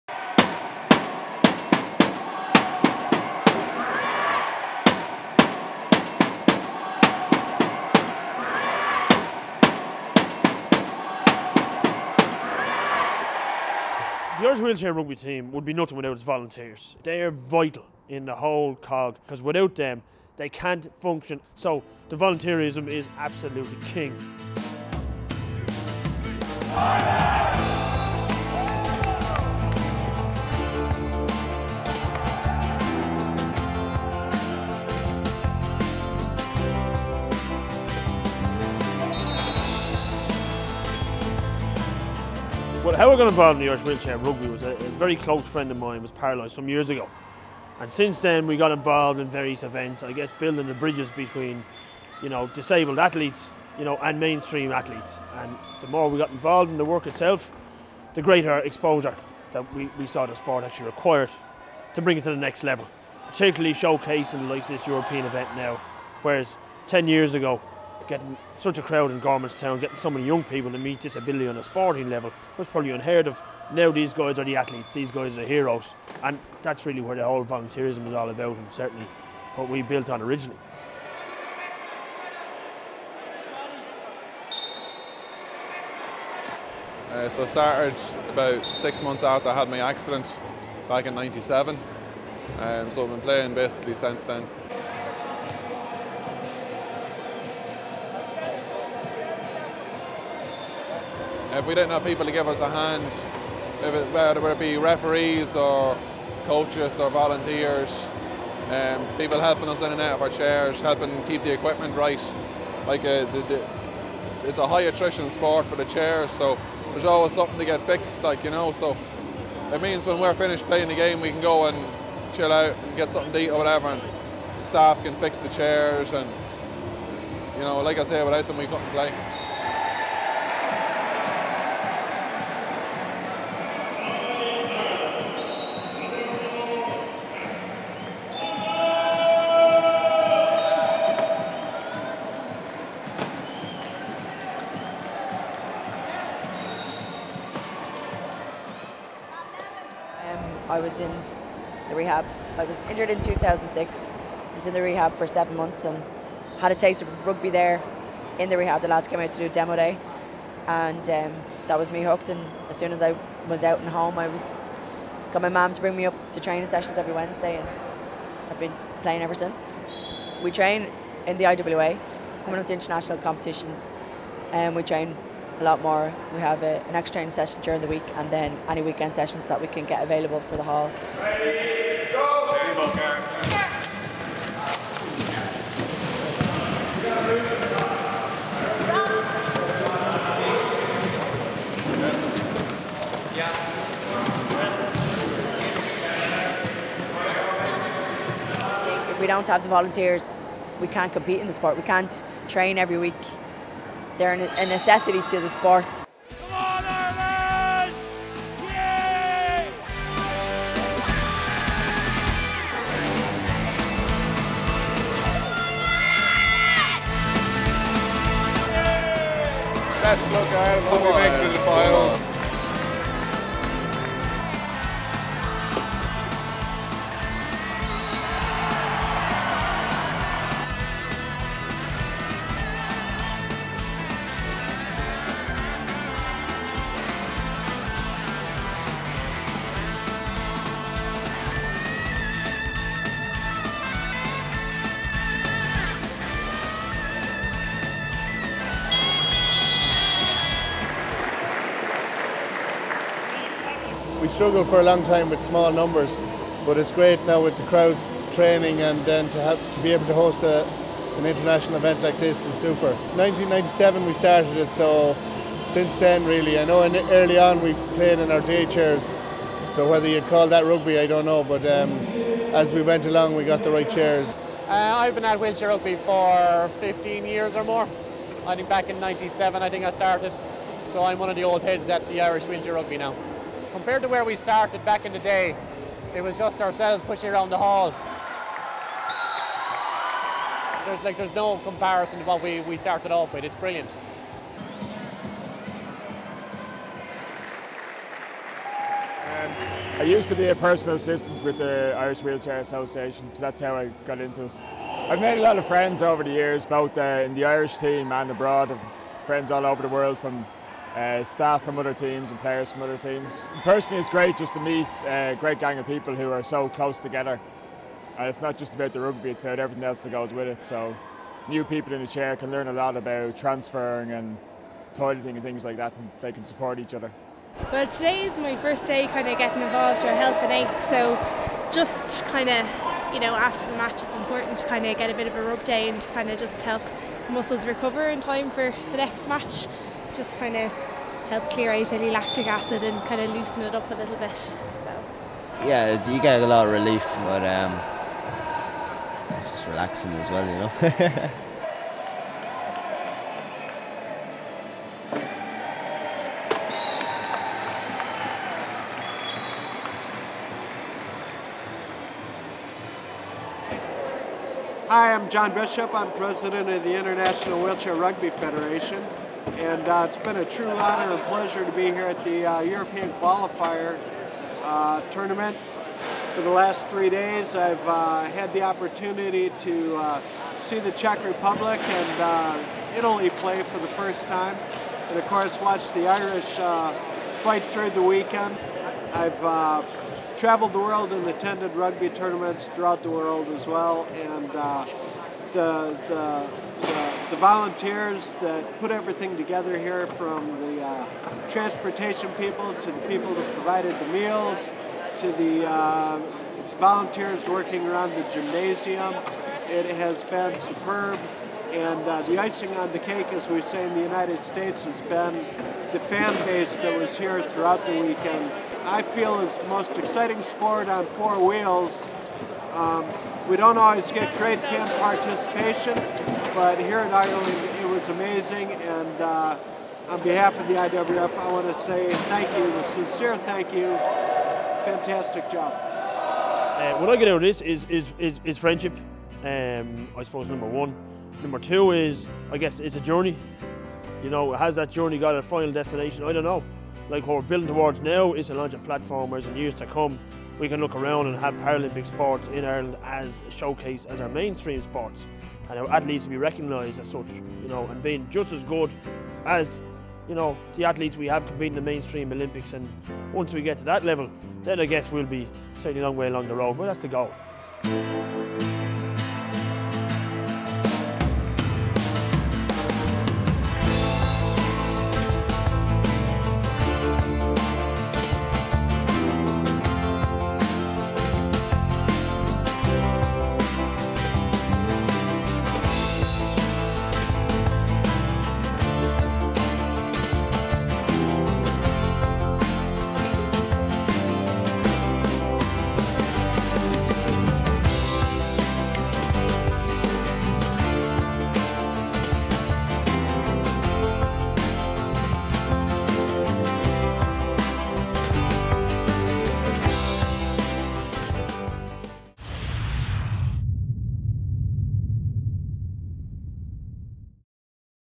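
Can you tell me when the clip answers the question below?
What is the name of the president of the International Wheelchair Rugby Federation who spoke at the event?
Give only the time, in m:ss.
6:05.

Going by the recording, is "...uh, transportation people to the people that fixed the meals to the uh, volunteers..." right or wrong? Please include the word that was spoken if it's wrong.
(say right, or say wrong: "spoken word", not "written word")
wrong: "provided", not "fixed".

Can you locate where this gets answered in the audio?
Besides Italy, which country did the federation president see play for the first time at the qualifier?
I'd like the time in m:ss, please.
6:20.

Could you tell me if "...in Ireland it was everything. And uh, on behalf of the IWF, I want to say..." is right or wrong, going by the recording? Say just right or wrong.
wrong.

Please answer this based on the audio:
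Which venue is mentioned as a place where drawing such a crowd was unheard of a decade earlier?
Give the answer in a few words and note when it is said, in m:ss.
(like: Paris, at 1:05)
Gormanston, at 1:09.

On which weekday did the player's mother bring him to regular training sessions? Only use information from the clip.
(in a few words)
Wednesday.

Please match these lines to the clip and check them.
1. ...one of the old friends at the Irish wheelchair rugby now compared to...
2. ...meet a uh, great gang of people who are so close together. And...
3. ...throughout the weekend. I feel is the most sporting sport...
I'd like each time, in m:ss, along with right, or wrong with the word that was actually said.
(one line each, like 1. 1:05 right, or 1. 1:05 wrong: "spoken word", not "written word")
1. 4:41 wrong: "heads", not "friends"
2. 5:14 right
3. 6:57 wrong: "exciting", not "sporting".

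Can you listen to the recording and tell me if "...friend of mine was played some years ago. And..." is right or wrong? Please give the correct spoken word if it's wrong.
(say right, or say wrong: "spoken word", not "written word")
wrong: "paralysed", not "played".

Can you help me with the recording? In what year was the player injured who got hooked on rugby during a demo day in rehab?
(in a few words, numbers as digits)
2006.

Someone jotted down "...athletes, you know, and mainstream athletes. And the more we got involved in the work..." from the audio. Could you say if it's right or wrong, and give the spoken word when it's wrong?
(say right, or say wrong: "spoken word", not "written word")
right.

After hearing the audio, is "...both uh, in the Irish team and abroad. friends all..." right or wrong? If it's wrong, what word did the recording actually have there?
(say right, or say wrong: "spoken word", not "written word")
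right.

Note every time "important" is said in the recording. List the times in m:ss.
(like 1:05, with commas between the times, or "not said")
5:34.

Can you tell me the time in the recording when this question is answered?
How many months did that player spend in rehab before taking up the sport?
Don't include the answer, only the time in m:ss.
2:35.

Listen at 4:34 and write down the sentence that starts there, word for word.
Uh, I've been at wheelchair rugby for 15 years or more.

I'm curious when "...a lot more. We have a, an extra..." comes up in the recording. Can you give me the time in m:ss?
2:55.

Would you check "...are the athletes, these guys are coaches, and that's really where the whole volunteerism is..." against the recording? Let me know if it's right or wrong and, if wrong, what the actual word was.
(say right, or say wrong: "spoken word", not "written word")
wrong: "heroes", not "coaches".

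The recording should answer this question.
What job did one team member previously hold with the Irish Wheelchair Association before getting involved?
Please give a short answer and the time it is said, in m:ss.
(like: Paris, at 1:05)
personal assistant, at 5:00.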